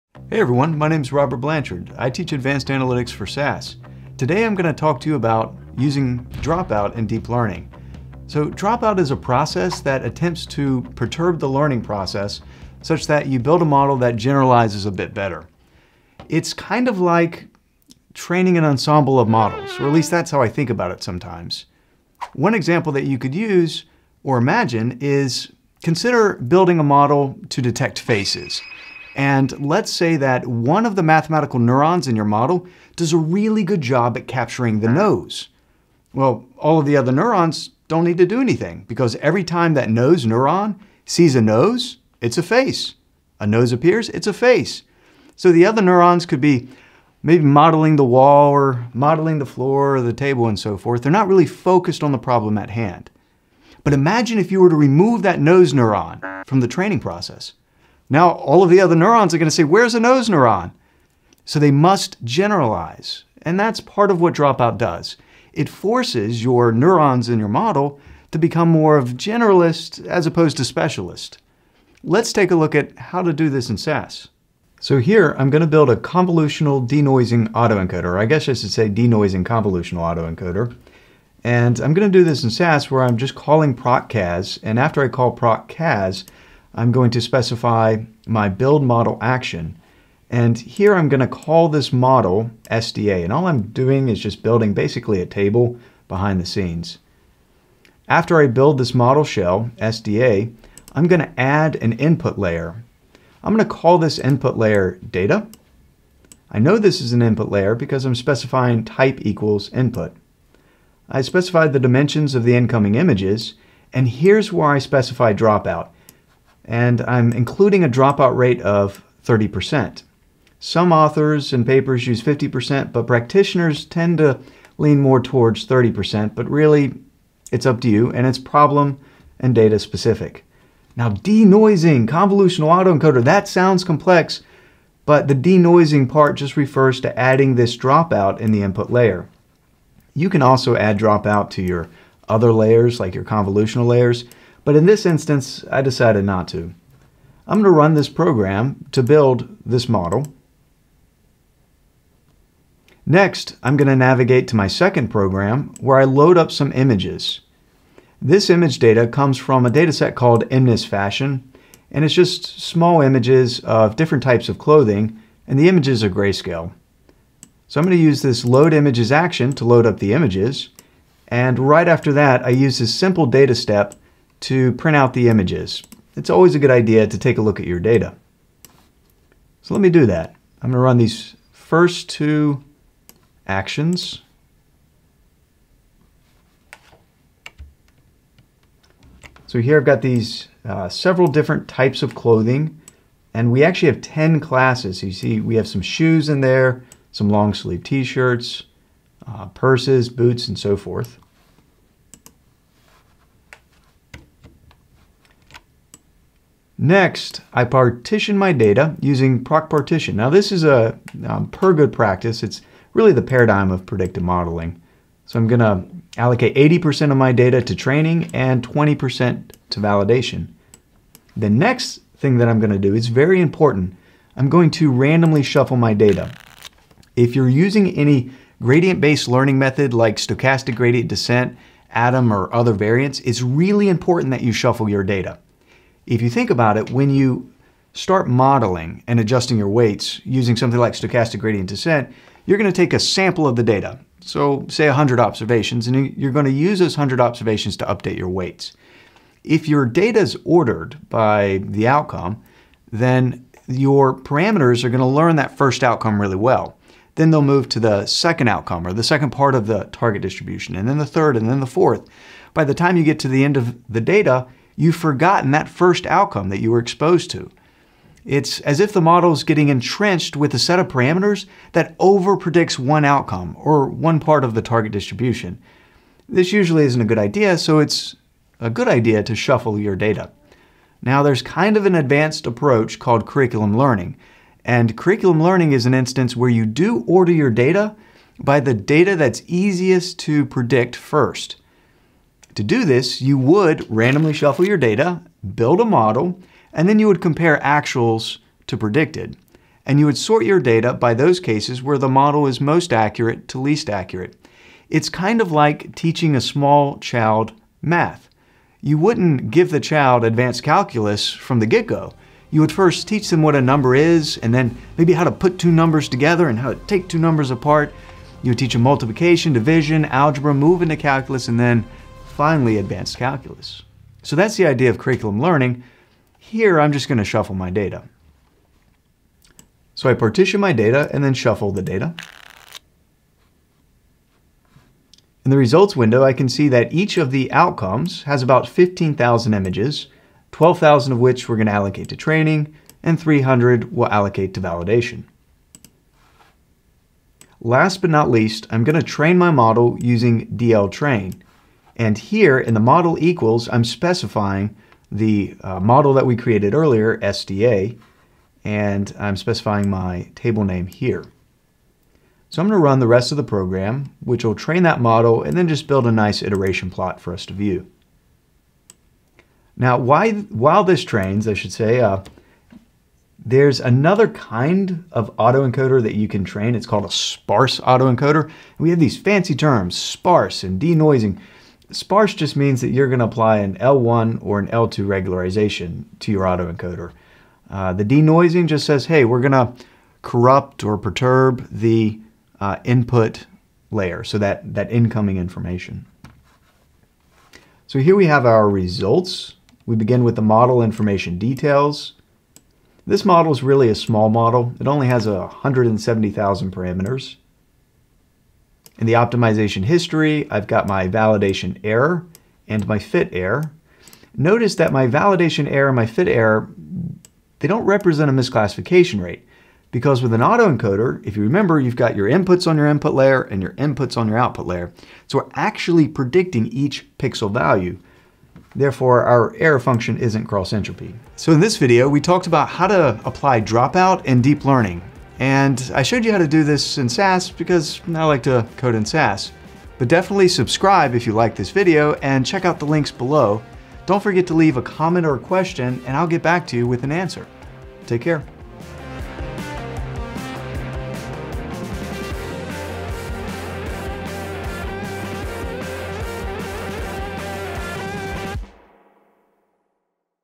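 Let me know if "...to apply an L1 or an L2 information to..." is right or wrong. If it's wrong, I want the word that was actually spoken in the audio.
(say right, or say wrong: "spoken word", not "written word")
wrong: "regularization", not "information".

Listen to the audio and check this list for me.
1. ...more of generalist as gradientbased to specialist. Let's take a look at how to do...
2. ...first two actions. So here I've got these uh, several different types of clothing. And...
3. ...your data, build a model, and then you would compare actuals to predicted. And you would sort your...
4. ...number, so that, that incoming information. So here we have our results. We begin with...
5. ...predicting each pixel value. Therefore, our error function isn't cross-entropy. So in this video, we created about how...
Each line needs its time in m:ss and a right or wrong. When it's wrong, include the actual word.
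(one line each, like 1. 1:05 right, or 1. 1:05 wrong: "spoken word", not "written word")
1. 1:08 wrong: "opposed", not "gradientbased"
2. 3:01 right
3. 4:54 right
4. 6:33 wrong: "layer", not "number"
5. 7:06 wrong: "talked", not "created".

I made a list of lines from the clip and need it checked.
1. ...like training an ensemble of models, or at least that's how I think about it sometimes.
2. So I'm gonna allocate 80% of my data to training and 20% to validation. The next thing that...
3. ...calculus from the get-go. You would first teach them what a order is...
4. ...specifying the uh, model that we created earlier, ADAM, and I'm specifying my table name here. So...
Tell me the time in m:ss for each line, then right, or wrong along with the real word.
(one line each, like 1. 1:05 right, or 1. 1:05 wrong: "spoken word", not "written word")
1. 0:17 right
2. 3:35 right
3. 5:10 wrong: "number", not "order"
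4. 5:53 wrong: "SDA", not "ADAM".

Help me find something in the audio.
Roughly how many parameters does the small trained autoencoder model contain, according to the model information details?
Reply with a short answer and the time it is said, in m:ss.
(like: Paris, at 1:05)
170,000, at 6:45.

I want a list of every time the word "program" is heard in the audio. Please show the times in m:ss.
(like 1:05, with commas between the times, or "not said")
2:28, 2:35, 6:03.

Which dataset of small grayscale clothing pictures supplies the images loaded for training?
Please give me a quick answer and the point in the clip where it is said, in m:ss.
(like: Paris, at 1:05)
MNIST Fashion, at 2:40.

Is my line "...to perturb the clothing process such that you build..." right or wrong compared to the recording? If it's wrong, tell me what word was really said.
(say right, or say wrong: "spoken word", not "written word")
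wrong: "learning", not "clothing".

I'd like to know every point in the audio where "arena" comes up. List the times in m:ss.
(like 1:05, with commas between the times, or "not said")
not said.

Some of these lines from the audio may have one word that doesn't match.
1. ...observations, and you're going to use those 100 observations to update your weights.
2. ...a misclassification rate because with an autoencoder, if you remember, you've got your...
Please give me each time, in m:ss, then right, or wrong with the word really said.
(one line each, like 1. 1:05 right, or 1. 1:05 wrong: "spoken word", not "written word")
1. 4:05 right
2. 6:58 right.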